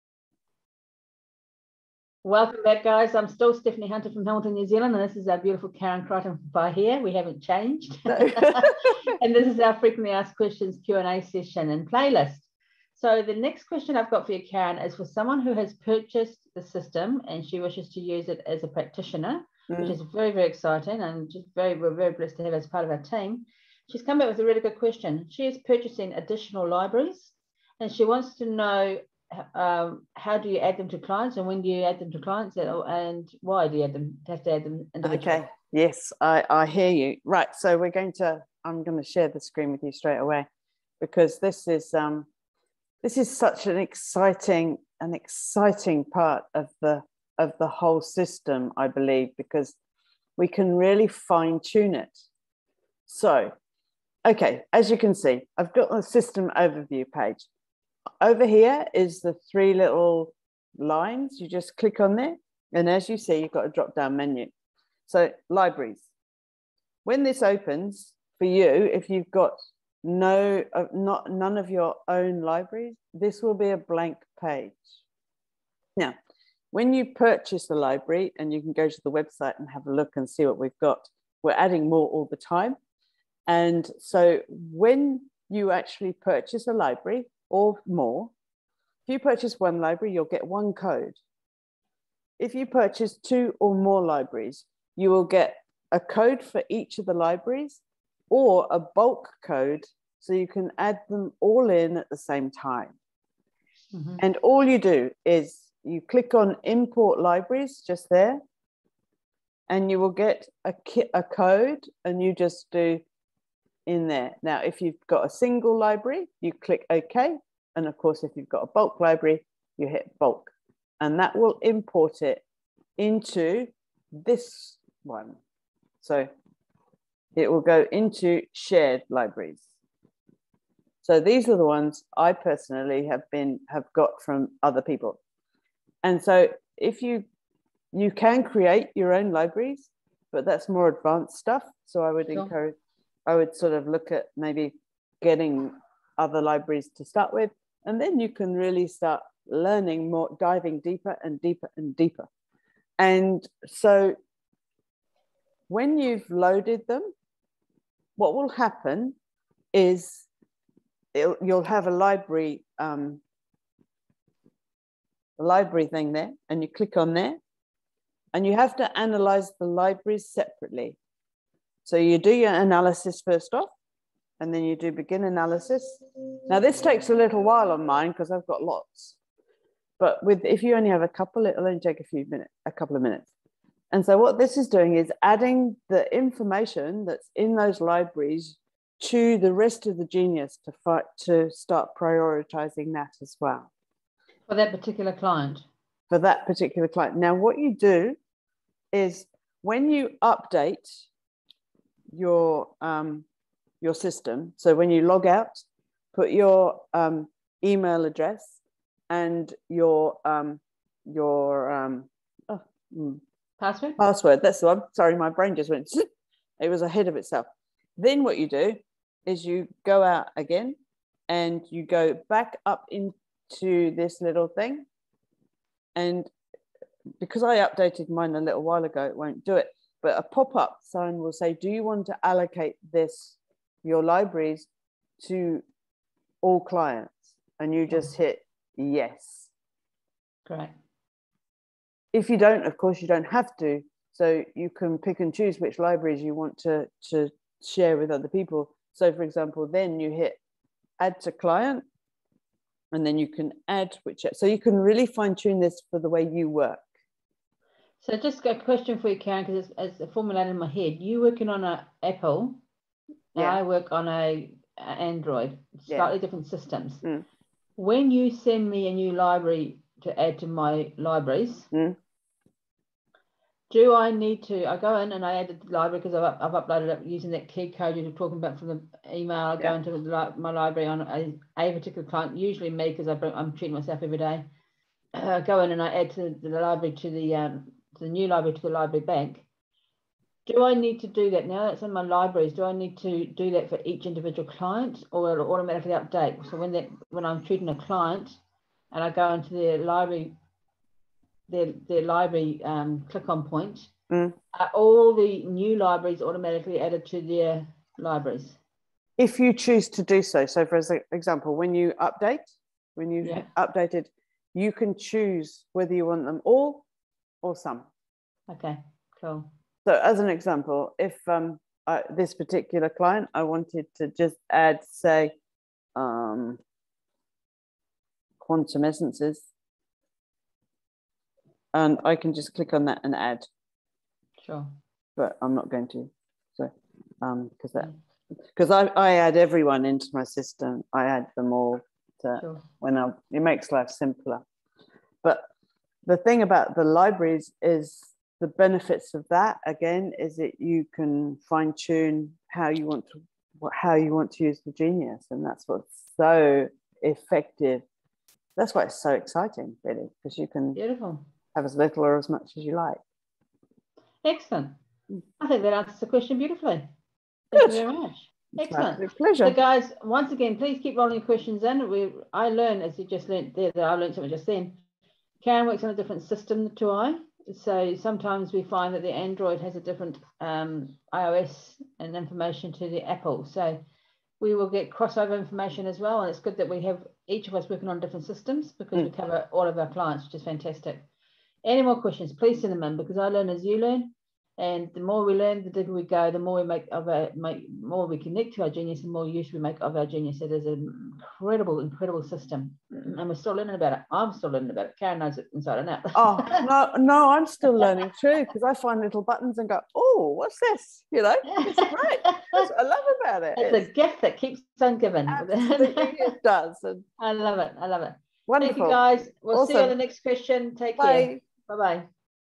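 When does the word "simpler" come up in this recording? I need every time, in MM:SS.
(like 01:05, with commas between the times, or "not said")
05:43.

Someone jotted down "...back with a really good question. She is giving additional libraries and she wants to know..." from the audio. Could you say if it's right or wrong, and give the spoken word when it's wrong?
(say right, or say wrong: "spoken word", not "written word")
wrong: "purchasing", not "giving".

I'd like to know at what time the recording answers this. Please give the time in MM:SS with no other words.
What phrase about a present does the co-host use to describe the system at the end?
06:53.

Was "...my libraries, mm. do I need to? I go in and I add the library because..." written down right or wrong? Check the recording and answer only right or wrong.
right.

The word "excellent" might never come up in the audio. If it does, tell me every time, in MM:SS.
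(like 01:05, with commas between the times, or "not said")
06:04, 06:08.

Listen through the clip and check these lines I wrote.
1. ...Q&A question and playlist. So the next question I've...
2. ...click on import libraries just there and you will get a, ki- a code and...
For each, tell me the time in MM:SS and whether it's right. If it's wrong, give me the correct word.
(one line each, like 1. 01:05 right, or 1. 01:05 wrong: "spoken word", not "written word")
1. 00:10 wrong: "session", not "question"
2. 01:46 right.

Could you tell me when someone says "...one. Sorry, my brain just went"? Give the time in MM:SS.
03:34.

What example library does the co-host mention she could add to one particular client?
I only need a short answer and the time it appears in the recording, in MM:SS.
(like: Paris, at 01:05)
Quantum essences, at 05:28.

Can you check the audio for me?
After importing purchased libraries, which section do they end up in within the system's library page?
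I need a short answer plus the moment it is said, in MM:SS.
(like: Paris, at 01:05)
Shared libraries, at 02:08.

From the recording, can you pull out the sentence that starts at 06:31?
Any more questions, please send them in because I learn as you learn.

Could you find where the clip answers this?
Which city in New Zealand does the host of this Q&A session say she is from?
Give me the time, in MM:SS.
00:04.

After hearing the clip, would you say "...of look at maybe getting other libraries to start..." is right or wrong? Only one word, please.
right.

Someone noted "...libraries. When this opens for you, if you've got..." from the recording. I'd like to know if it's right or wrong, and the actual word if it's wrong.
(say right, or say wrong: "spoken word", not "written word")
right.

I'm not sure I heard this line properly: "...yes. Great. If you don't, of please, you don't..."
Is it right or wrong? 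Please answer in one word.
wrong.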